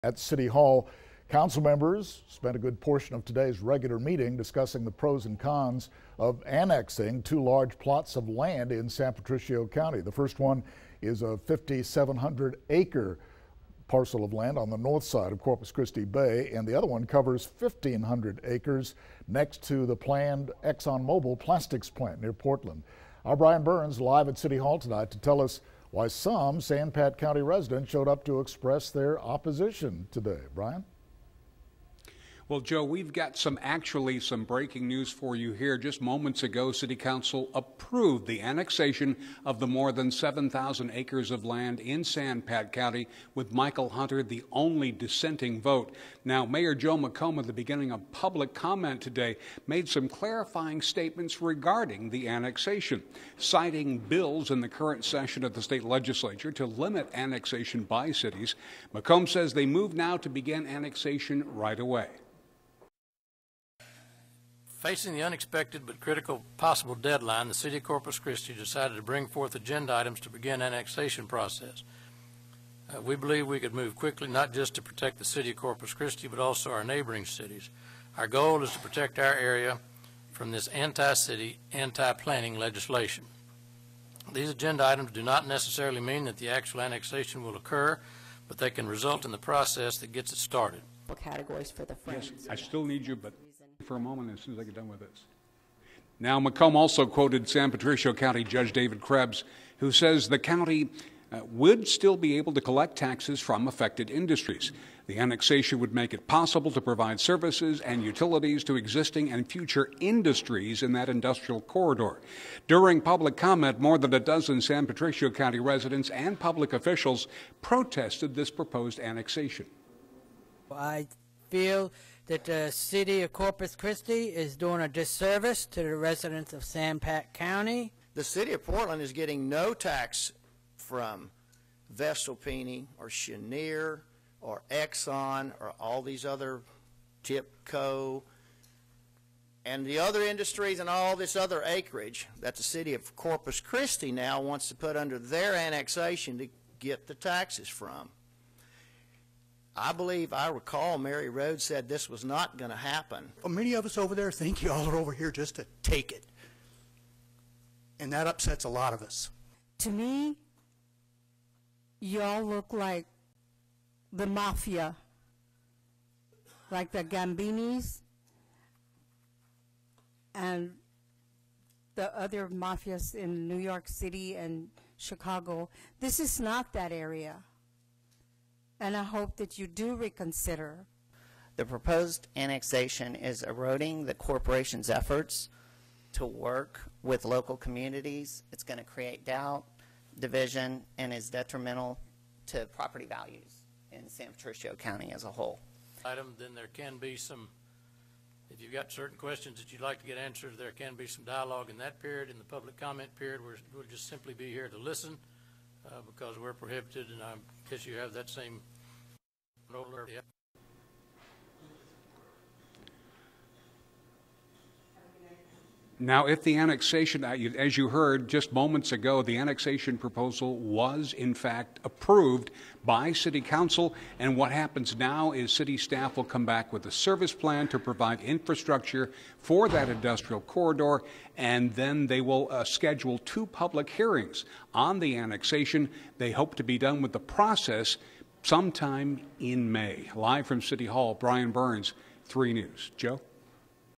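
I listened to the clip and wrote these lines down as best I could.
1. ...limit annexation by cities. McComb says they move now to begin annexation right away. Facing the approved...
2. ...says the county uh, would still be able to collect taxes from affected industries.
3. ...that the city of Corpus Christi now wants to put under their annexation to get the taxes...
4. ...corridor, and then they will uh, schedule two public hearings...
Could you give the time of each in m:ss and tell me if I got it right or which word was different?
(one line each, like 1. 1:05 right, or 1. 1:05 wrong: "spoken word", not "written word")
1. 0:56 wrong: "unexpected", not "approved"
2. 1:39 right
3. 2:22 right
4. 3:50 right.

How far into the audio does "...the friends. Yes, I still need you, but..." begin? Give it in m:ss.
1:31.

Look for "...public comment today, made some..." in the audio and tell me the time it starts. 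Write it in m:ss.
0:48.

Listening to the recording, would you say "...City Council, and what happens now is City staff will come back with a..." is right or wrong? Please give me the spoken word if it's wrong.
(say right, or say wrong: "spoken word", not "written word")
right.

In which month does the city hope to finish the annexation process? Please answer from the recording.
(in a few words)
May.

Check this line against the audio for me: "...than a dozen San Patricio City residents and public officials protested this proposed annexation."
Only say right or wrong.
wrong.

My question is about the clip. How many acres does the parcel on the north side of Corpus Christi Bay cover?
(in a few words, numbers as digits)
5,700.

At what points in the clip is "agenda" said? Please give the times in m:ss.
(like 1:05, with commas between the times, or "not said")
1:09, 1:24.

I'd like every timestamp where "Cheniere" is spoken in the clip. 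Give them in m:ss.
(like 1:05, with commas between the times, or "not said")
2:13.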